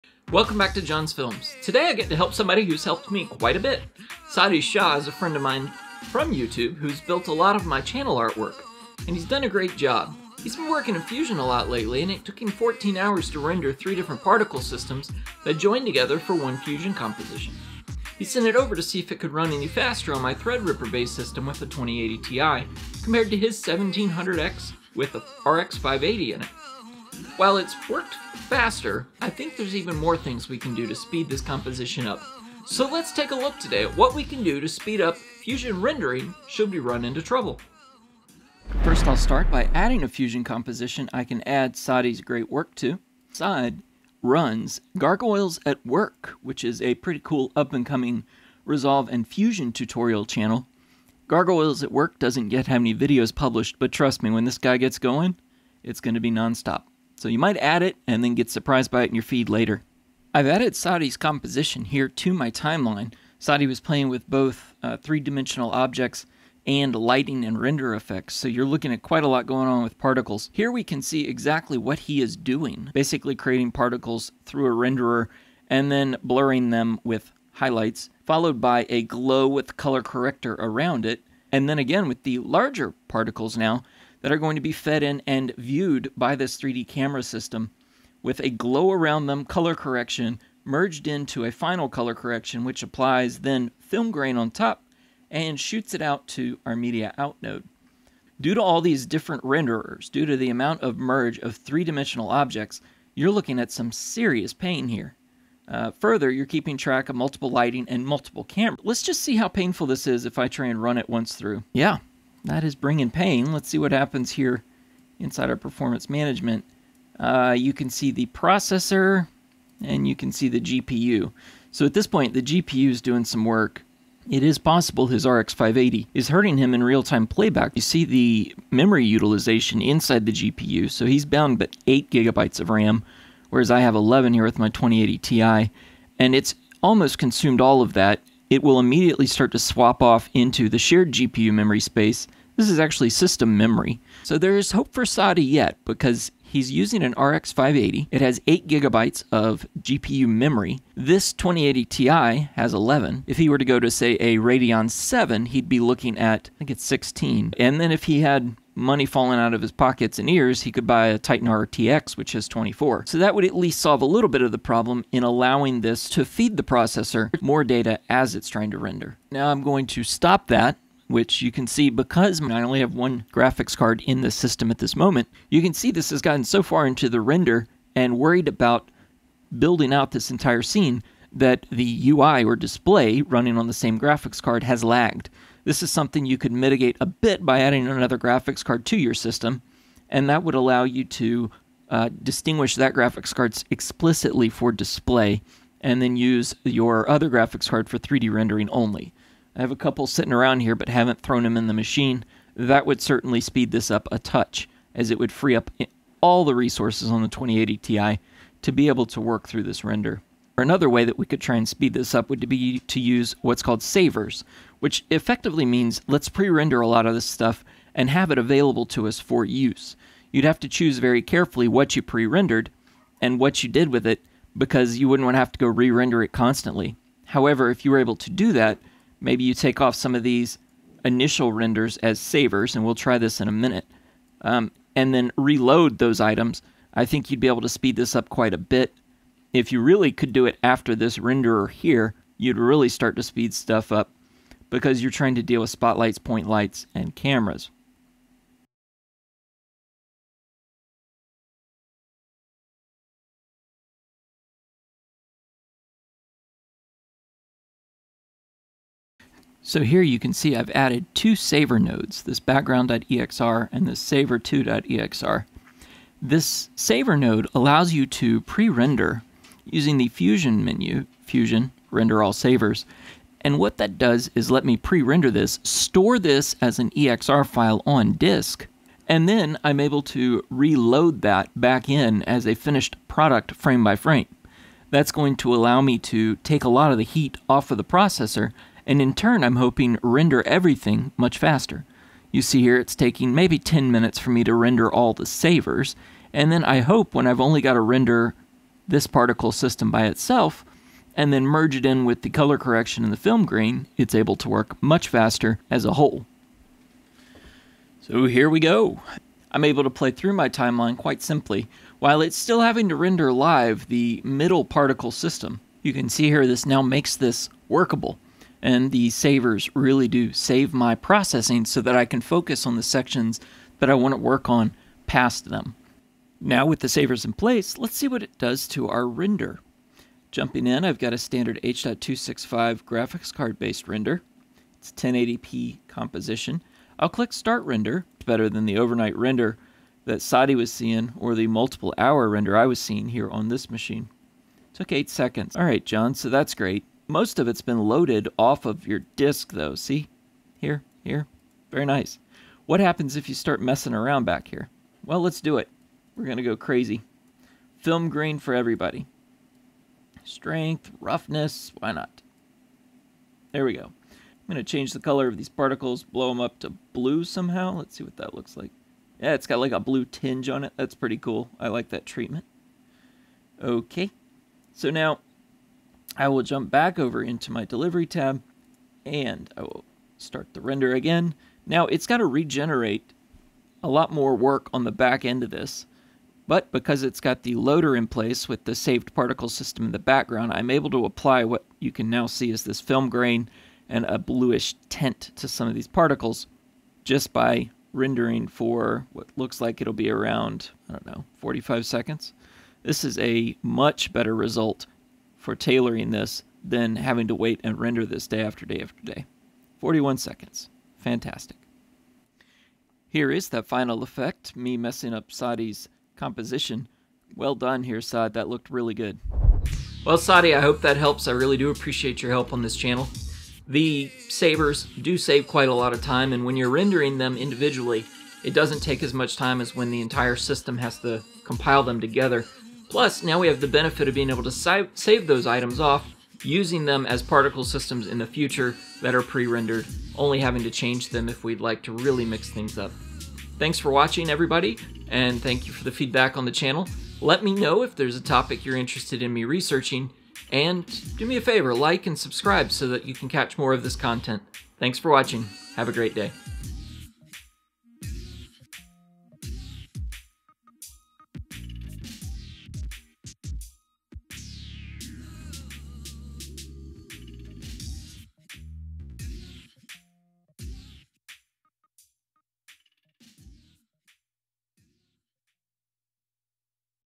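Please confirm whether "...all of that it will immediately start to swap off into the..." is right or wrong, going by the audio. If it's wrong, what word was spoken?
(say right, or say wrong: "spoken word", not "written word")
right.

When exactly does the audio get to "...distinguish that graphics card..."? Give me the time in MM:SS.
03:12.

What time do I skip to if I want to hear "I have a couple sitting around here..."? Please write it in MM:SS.
03:19.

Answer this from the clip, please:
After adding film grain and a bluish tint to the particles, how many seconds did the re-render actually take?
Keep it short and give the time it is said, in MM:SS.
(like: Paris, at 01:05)
41 seconds, at 06:49.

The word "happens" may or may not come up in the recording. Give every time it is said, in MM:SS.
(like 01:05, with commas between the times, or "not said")
01:53, 05:52.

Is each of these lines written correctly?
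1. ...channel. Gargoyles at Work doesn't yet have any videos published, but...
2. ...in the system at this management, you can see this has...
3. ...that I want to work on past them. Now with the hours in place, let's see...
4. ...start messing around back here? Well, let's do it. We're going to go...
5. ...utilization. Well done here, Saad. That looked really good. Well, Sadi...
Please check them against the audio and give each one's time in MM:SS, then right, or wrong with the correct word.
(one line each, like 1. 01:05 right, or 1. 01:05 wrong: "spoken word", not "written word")
1. 00:50 right
2. 02:54 wrong: "moment", not "management"
3. 05:23 wrong: "savers", not "hours"
4. 05:53 right
5. 06:56 wrong: "composition", not "utilization".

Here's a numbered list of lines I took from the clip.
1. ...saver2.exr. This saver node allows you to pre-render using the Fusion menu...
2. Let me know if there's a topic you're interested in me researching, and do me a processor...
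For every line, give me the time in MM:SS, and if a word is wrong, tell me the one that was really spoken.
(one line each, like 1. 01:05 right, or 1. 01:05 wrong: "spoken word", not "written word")
1. 04:24 right
2. 07:27 wrong: "favor", not "processor".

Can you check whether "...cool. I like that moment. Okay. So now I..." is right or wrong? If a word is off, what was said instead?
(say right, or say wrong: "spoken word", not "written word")
wrong: "treatment", not "moment".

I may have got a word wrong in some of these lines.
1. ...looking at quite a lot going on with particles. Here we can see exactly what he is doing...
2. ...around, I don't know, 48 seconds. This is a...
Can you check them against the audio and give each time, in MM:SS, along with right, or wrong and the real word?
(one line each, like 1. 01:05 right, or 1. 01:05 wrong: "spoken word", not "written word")
1. 01:08 right
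2. 06:40 wrong: "45", not "48".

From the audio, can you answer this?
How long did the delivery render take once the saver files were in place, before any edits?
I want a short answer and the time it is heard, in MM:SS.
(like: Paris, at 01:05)
8 seconds, at 05:44.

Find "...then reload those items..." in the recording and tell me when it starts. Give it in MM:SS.
03:55.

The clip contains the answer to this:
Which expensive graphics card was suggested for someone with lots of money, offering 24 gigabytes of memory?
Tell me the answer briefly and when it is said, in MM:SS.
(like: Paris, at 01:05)
Titan RTX, at 02:41.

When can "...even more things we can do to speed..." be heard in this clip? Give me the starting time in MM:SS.
00:29.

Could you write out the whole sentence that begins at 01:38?
Due to all these different renderers, due to the amount of merge of three-dimensional objects, you're looking at some serious pain here.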